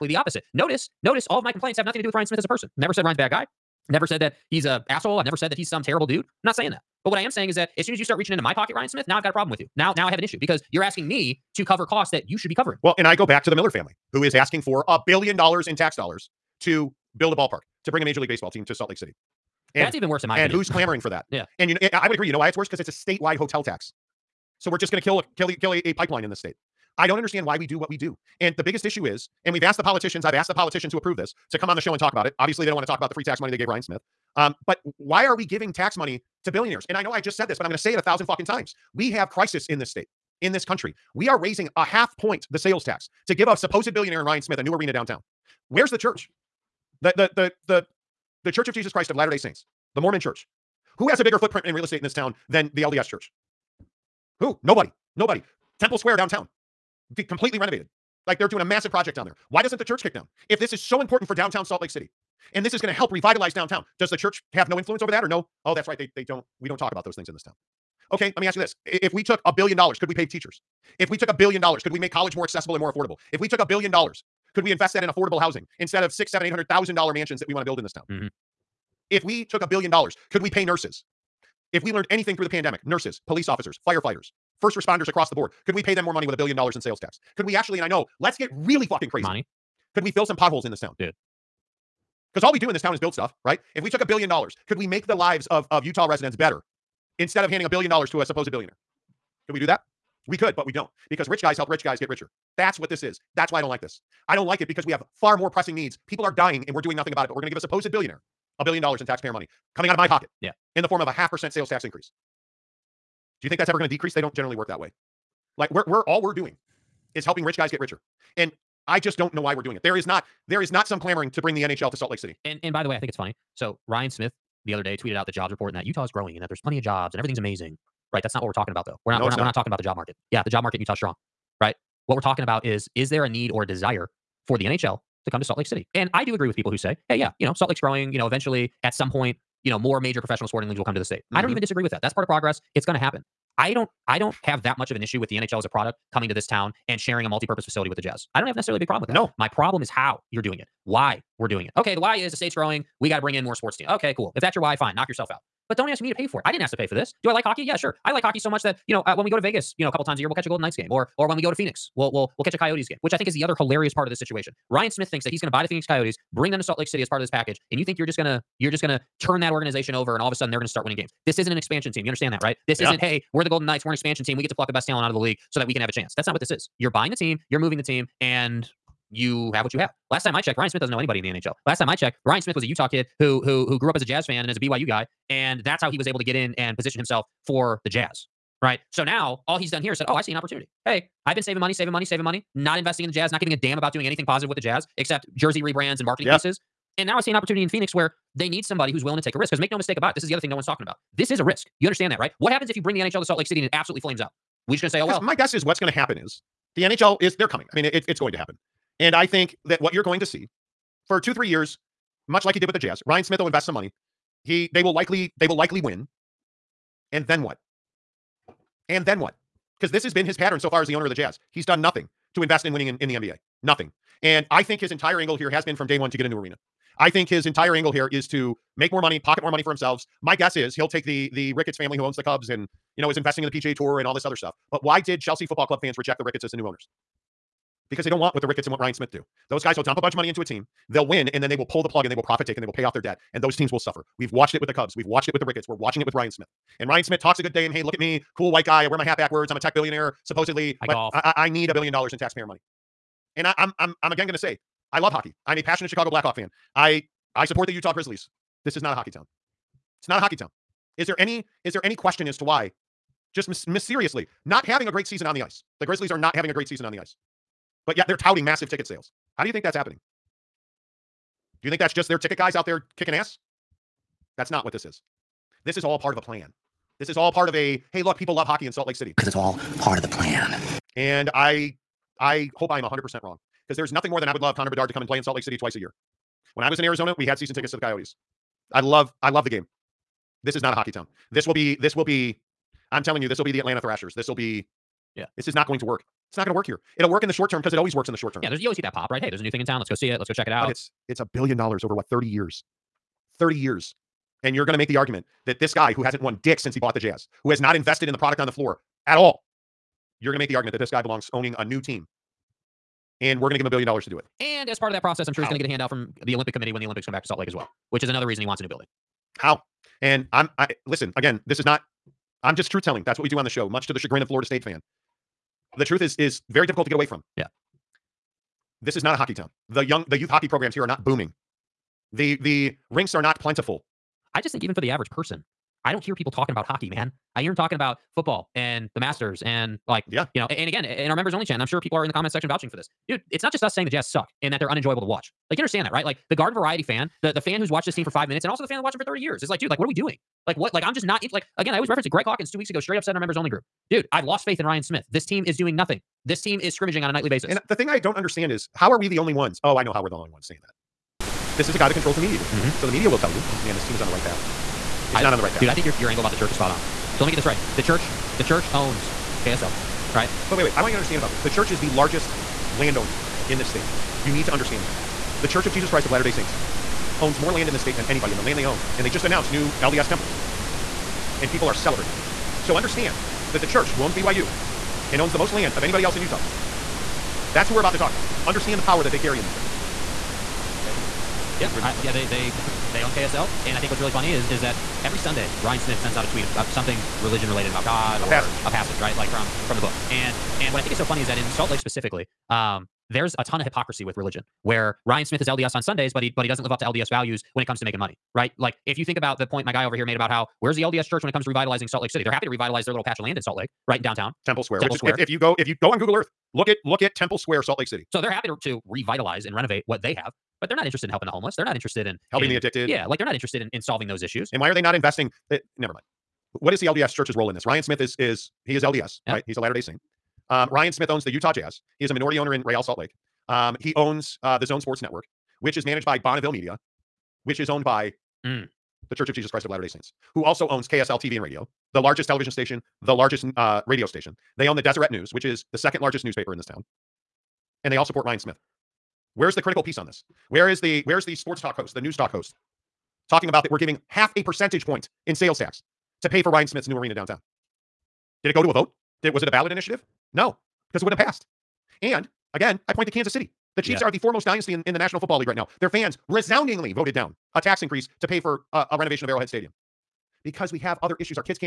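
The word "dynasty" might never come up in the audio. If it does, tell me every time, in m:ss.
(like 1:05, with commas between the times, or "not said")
7:44.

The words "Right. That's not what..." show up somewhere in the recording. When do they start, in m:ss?
2:08.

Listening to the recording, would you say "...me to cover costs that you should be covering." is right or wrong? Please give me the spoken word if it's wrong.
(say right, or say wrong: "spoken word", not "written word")
right.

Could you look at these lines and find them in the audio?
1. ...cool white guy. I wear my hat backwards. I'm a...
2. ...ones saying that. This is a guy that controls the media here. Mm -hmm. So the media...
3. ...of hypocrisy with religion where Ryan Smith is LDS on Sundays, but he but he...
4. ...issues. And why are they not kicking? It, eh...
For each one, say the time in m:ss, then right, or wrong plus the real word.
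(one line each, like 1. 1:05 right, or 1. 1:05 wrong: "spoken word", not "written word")
1. 4:08 right
2. 6:00 right
3. 6:43 right
4. 7:04 wrong: "investing", not "kicking".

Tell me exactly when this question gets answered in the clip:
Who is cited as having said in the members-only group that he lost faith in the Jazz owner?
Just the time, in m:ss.
5:52.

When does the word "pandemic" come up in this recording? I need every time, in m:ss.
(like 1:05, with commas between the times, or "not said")
1:22.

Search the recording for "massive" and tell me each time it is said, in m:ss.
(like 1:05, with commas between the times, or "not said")
0:58, 4:28.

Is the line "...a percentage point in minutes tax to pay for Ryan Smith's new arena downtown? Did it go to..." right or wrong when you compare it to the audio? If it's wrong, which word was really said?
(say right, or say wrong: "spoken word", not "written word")
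wrong: "sales", not "minutes".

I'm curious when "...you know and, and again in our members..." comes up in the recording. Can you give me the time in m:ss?
5:40.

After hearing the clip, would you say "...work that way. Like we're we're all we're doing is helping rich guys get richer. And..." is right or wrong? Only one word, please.
right.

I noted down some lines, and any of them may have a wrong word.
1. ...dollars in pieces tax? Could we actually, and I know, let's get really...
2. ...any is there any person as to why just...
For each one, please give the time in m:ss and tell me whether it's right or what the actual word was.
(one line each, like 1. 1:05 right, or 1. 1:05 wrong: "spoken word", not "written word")
1. 1:26 wrong: "sales", not "pieces"
2. 4:21 wrong: "question", not "person".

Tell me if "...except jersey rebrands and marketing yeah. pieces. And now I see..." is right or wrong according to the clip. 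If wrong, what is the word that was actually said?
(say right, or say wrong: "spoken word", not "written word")
right.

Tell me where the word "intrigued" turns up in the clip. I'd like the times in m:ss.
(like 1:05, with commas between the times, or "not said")
not said.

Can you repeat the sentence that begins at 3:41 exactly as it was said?
He's done nothing to invest in winning in, in the NBA.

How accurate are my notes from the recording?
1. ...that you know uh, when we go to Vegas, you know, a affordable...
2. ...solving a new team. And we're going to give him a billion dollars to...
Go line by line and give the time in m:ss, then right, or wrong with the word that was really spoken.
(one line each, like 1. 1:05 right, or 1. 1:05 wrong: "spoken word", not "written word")
1. 2:38 wrong: "couple", not "affordable"
2. 5:11 wrong: "owning", not "solving".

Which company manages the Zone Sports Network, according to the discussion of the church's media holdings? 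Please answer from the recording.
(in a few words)
Bonneville Media.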